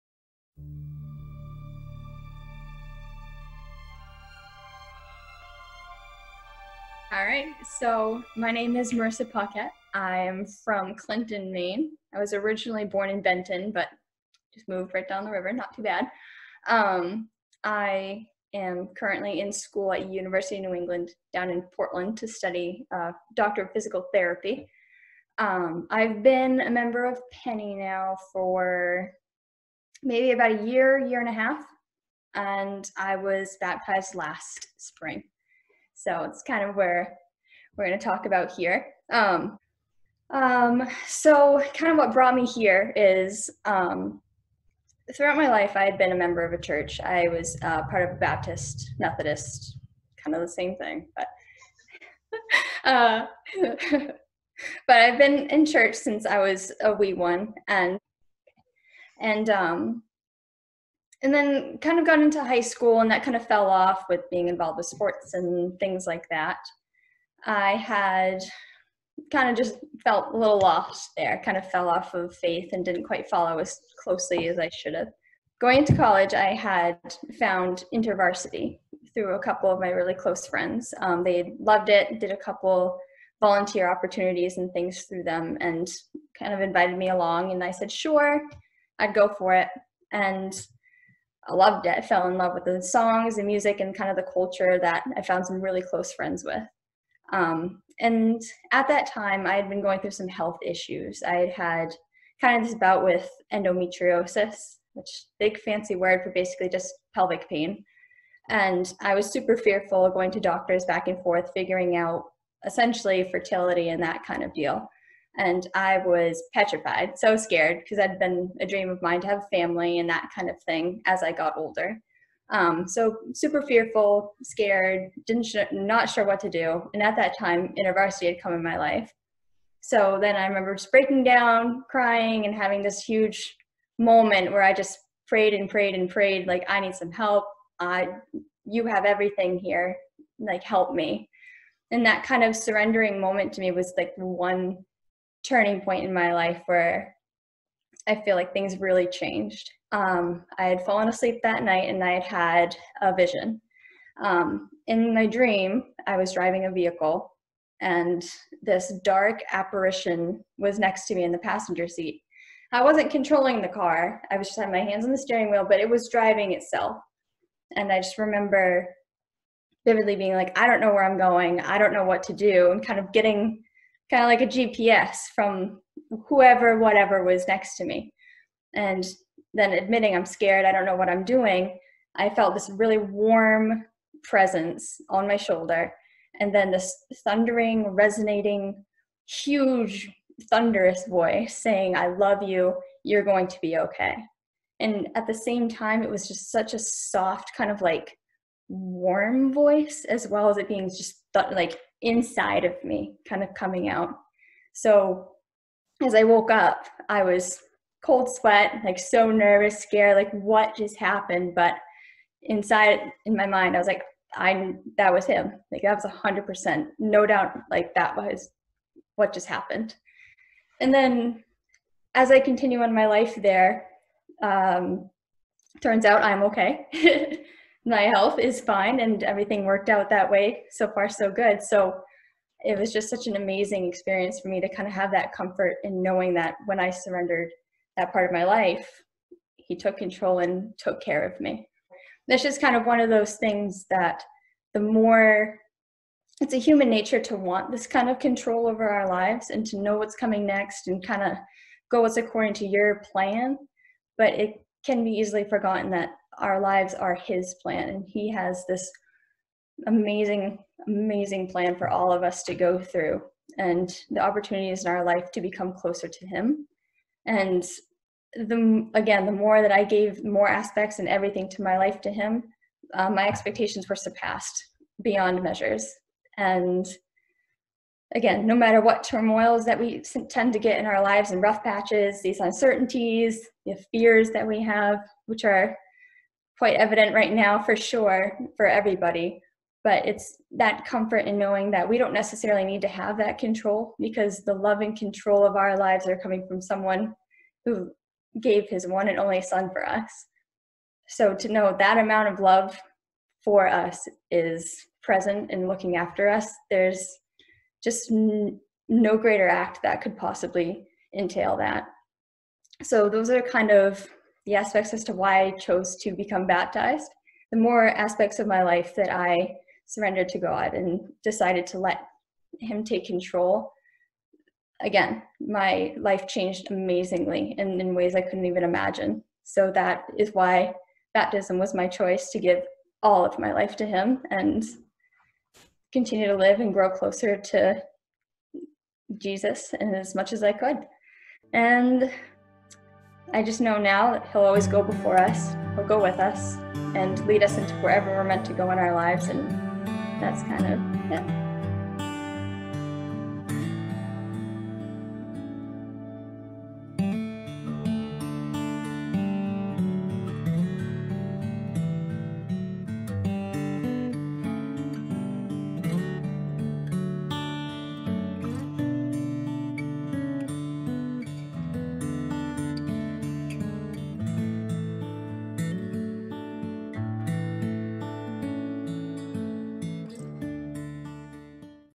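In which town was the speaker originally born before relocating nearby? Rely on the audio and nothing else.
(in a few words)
Benton.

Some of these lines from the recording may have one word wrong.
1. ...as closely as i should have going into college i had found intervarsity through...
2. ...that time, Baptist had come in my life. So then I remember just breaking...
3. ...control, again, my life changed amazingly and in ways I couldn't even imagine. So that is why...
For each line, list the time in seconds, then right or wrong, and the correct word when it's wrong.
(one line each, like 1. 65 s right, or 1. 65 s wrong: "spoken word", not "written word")
1. 73 s right
2. 127 s wrong: "InterVarsity", not "Baptist"
3. 323 s right.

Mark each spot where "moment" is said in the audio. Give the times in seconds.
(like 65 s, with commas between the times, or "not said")
133 s, 143 s.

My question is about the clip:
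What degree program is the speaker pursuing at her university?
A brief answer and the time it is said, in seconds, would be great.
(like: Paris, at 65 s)
Doctor of Physical Therapy, at 23 s.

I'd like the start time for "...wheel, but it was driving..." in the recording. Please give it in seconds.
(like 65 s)
165 s.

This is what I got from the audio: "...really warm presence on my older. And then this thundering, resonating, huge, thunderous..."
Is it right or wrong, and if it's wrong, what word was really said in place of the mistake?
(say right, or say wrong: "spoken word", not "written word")
wrong: "shoulder", not "older".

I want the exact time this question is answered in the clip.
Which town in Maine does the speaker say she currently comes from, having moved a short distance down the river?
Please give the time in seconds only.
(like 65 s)
10 s.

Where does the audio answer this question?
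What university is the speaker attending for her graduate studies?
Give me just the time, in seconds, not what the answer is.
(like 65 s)
20 s.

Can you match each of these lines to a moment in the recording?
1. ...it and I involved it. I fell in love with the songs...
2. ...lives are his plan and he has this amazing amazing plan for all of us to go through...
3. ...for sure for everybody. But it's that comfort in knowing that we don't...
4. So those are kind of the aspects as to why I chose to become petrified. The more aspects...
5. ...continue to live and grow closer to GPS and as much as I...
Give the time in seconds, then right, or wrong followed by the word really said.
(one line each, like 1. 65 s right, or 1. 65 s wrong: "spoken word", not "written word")
1. 89 s wrong: "loved", not "involved"
2. 256 s right
3. 287 s right
4. 312 s wrong: "baptized", not "petrified"
5. 335 s wrong: "Jesus", not "GPS".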